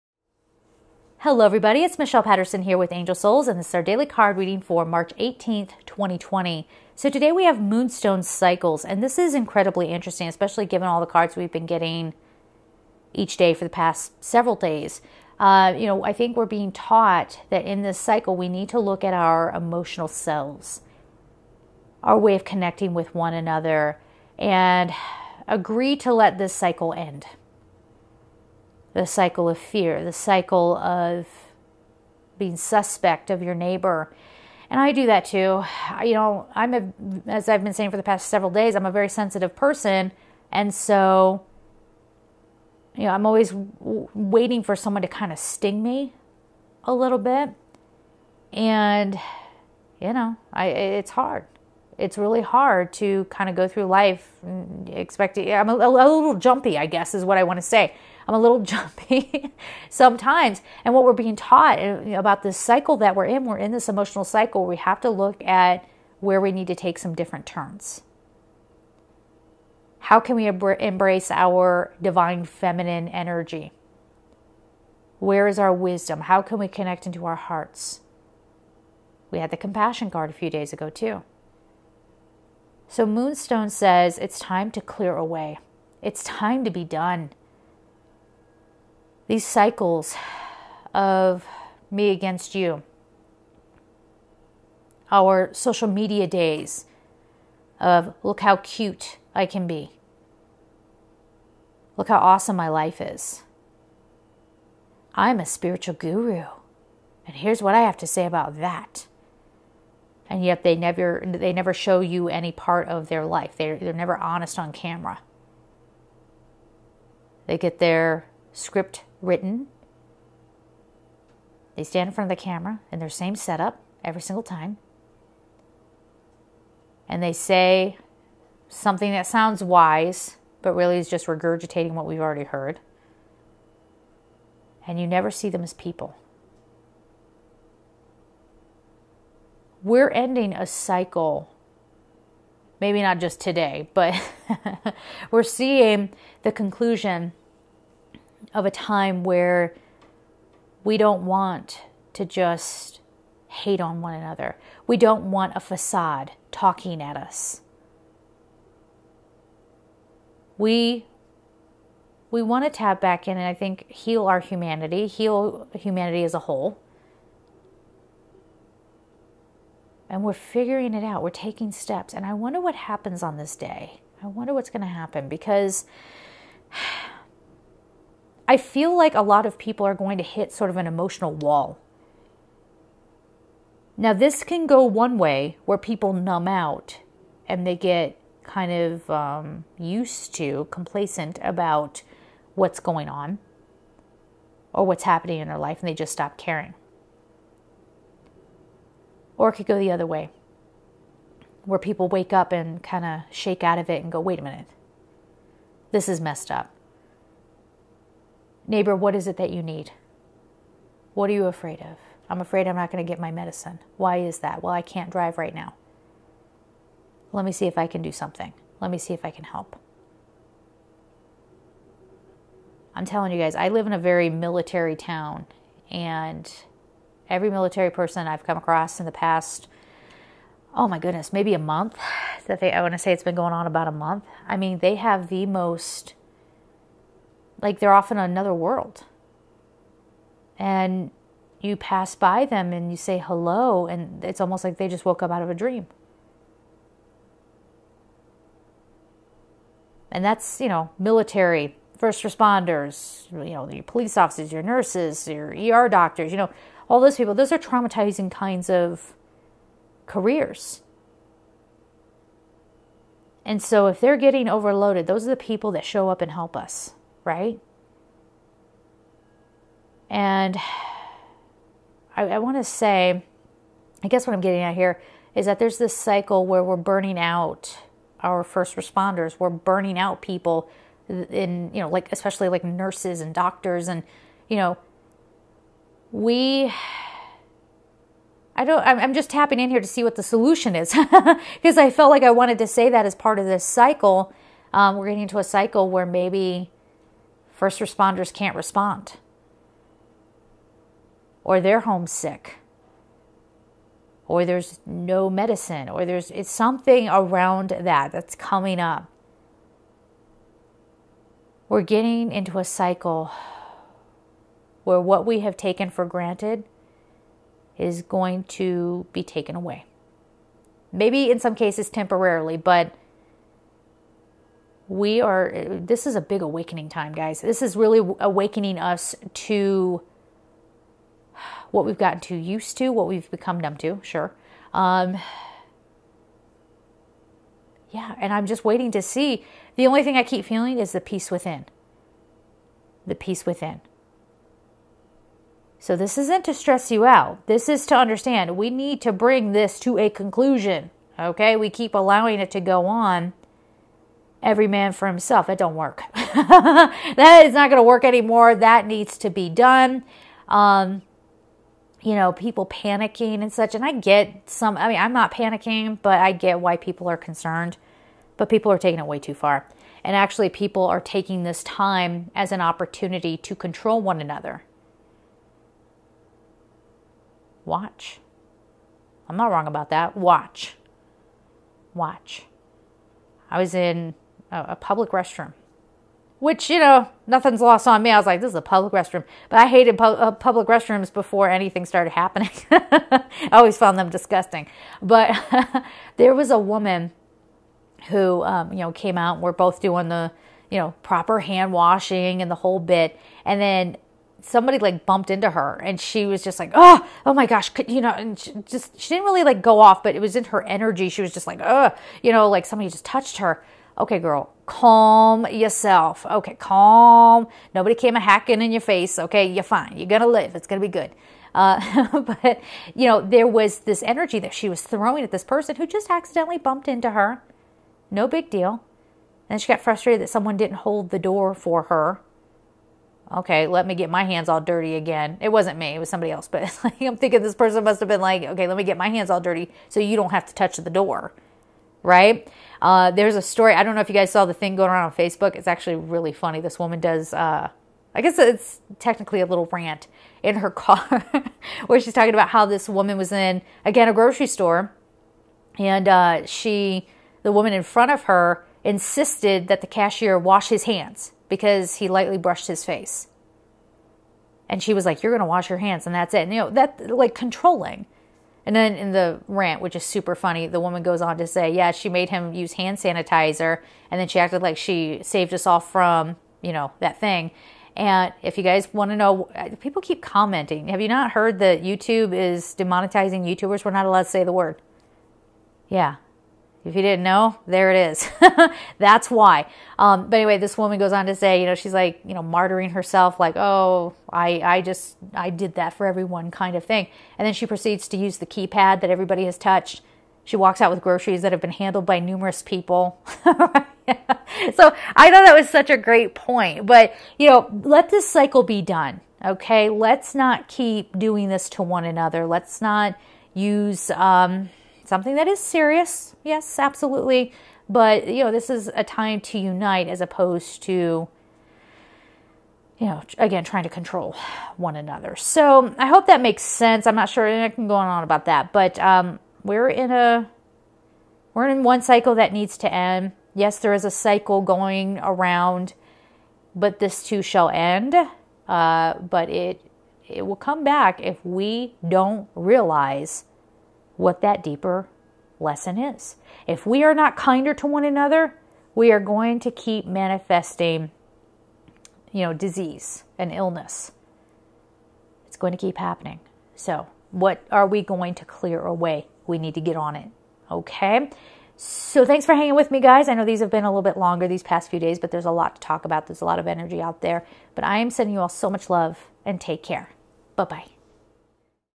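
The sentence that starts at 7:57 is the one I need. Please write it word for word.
And if you guys want to know, people keep commenting.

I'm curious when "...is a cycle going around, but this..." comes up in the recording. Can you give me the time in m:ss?
8:53.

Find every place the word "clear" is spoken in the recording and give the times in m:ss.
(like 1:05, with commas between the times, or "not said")
1:24, 9:18.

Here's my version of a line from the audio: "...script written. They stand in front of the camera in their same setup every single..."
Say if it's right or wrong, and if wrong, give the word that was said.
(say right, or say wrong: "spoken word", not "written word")
right.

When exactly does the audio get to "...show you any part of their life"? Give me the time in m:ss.
1:51.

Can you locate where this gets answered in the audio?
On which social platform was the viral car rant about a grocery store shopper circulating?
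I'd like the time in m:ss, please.
7:25.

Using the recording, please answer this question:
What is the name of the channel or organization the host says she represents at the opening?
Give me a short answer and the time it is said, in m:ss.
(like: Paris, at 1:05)
Angel Souls, at 0:02.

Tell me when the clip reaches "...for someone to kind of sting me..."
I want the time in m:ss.
0:44.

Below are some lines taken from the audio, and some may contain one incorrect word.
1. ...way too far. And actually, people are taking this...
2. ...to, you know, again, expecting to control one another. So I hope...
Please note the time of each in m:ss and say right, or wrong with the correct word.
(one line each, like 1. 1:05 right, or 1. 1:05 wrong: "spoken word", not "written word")
1. 6:09 right
2. 8:40 wrong: "trying", not "expecting".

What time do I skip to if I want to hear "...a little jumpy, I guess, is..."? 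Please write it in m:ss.
0:55.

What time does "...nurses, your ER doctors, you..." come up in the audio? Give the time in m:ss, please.
4:14.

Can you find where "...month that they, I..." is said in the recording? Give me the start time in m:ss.
3:51.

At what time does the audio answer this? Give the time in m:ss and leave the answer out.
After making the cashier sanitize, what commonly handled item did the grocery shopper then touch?
8:18.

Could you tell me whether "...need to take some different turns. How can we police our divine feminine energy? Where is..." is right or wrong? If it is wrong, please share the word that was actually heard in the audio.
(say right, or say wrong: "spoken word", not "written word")
wrong: "embrace", not "police".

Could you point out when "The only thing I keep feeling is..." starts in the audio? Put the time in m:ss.
5:39.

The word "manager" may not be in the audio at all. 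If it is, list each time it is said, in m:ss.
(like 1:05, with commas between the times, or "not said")
not said.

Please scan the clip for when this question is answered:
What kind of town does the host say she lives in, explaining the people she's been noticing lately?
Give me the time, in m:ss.
3:44.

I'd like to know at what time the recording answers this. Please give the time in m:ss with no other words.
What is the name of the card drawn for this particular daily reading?
0:07.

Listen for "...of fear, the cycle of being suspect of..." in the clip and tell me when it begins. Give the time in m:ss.
0:29.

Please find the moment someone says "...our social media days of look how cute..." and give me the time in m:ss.
1:35.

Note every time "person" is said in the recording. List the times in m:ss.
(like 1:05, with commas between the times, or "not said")
0:39, 3:47, 7:05, 7:17.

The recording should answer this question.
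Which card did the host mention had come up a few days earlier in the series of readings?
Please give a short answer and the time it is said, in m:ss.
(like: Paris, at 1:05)
compassion, at 1:19.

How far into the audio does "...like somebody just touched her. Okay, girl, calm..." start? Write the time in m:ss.
6:52.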